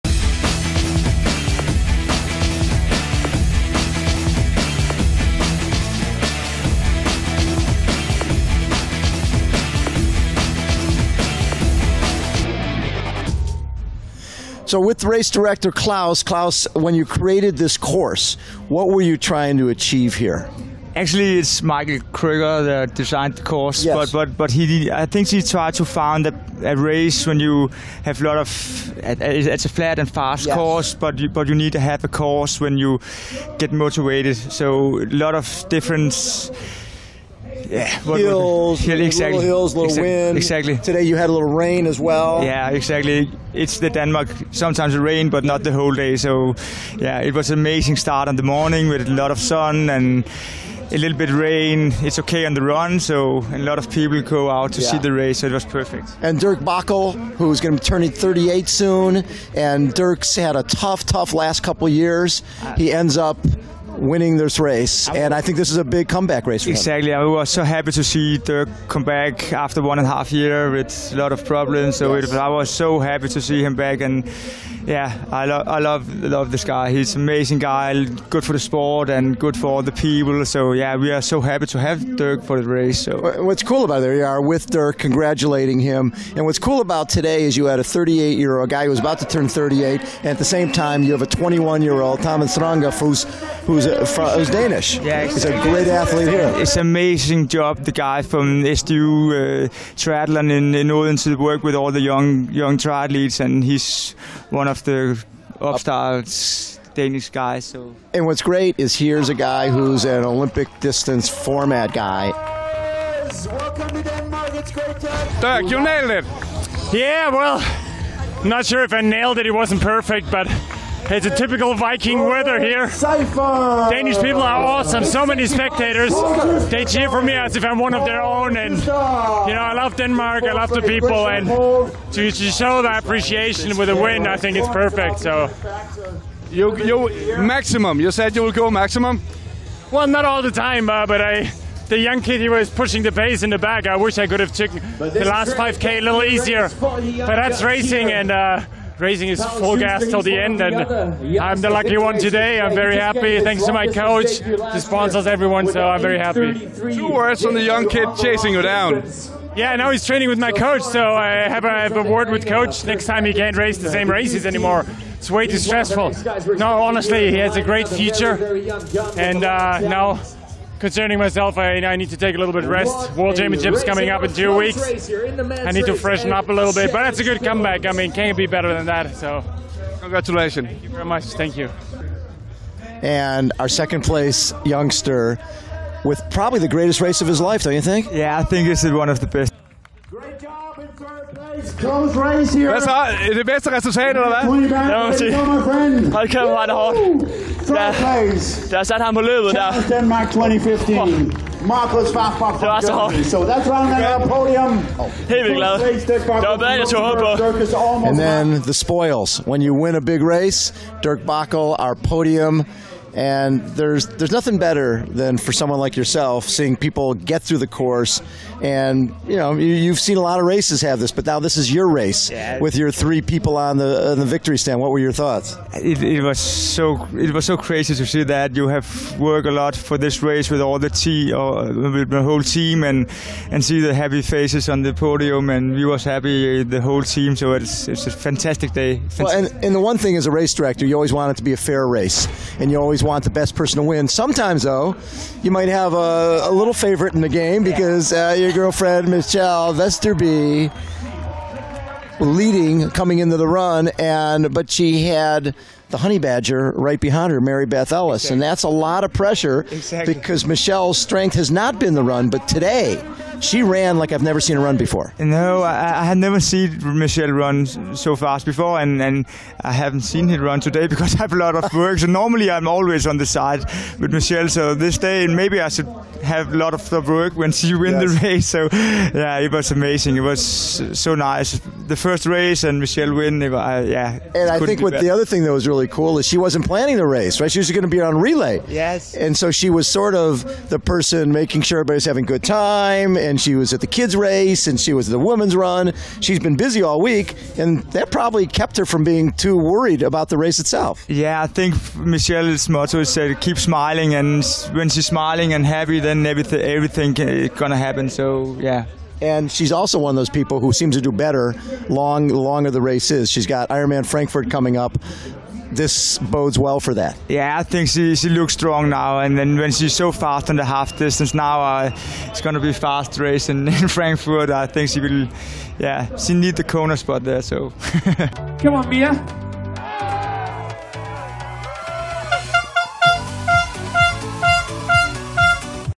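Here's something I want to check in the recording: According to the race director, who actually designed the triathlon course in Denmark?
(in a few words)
Michael Krieger.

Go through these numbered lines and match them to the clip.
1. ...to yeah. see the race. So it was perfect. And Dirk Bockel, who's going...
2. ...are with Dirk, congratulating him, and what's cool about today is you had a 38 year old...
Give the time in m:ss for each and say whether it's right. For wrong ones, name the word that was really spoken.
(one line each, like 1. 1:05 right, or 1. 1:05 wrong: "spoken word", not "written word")
1. 0:54 right
2. 1:24 right.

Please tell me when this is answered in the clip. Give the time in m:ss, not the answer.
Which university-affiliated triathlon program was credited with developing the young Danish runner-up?
1:38.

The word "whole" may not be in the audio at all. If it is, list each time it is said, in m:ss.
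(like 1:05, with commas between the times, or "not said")
0:45, 3:52, 3:56.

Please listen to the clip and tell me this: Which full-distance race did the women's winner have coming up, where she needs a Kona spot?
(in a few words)
Ironman Frankfurt.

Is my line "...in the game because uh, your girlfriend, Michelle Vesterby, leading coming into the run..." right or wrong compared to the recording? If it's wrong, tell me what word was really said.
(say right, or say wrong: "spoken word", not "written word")
right.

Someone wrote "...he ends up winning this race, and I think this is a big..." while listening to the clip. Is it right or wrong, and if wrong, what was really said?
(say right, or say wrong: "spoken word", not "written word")
right.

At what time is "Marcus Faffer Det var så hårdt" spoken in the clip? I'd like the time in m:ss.
3:21.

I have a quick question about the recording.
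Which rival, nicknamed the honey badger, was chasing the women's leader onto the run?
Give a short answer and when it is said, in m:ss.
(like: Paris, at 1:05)
Mary Beth Ellis, at 4:17.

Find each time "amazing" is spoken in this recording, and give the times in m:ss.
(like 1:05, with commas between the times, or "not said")
0:47, 1:17, 1:36, 4:39.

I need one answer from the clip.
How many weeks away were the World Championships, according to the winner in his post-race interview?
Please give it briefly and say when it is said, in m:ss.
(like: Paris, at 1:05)
2, at 2:54.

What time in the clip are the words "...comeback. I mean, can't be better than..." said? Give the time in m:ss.
2:57.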